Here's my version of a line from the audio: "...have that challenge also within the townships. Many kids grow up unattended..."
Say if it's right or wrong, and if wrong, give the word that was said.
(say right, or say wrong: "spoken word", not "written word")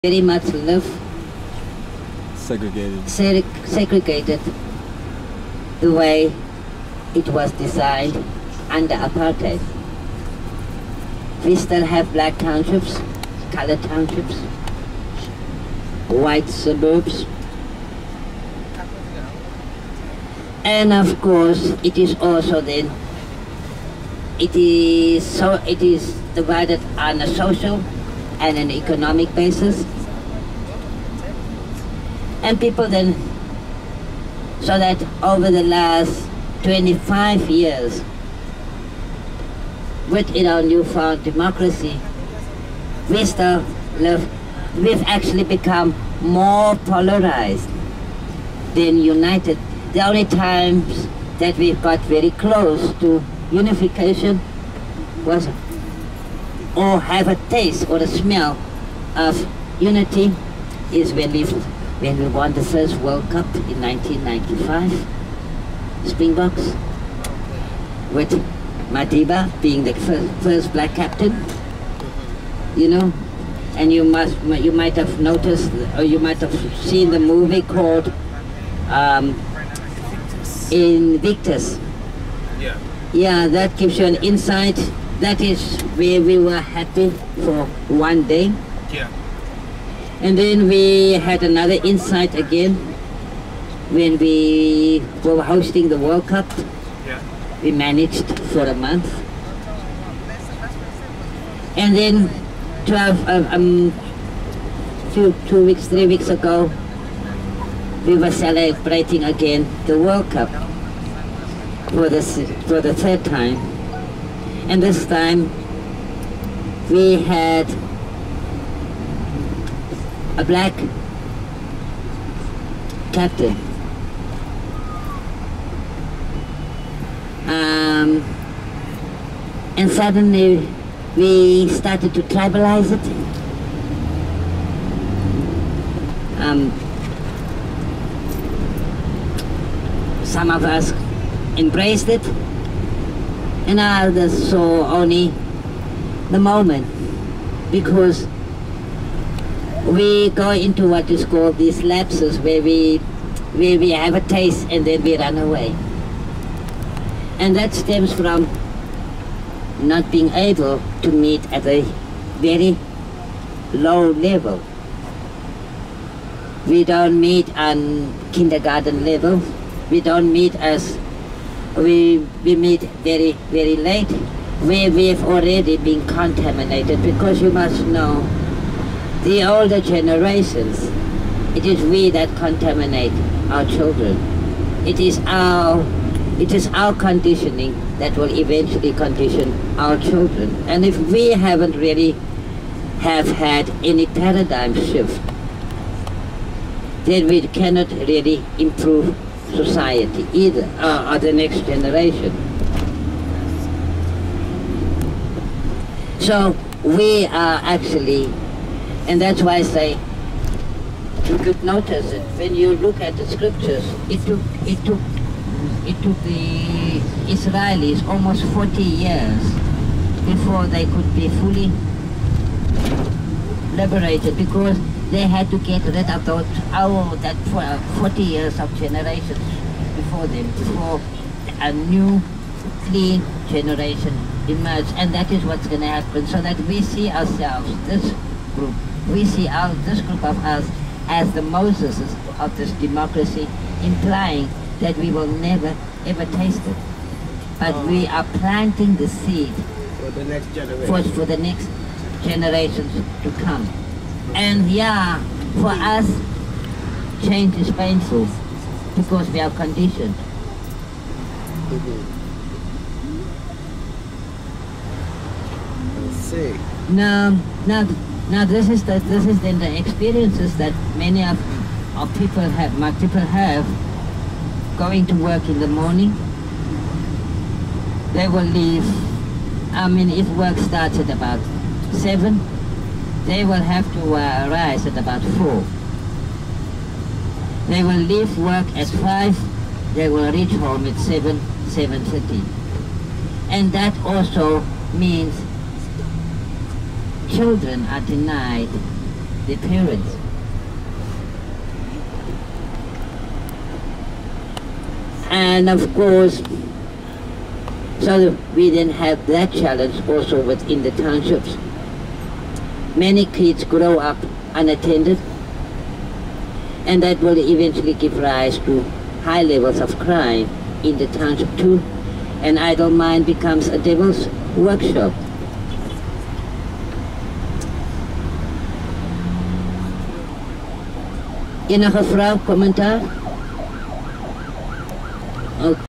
right.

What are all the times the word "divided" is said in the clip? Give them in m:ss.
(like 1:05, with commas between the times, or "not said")
0:26.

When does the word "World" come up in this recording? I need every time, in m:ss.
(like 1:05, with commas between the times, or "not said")
1:02, 1:35, 1:49.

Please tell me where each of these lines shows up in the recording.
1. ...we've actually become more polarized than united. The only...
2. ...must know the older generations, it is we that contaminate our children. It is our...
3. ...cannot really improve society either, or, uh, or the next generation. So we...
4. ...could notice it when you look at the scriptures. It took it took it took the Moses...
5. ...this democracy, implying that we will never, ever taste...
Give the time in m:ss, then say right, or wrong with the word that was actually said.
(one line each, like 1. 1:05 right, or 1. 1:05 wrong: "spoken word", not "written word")
1. 0:44 right
2. 2:57 right
3. 3:17 right
4. 3:31 wrong: "Israelis", not "Moses"
5. 4:02 right.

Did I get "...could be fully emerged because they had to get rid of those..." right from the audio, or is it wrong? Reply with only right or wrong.
wrong.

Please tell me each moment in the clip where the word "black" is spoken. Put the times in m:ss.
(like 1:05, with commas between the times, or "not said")
0:12, 1:10, 2:00.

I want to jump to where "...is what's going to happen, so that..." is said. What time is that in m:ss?
3:55.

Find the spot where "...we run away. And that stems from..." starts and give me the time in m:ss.
2:35.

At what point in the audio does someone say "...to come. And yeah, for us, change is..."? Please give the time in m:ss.
4:13.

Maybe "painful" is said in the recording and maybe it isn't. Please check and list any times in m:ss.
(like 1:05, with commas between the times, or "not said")
4:17.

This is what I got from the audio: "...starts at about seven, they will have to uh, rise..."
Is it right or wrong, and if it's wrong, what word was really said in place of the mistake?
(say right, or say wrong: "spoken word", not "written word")
right.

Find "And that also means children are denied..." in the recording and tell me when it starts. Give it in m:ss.
4:53.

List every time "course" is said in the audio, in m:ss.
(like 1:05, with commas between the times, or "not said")
0:21, 5:05.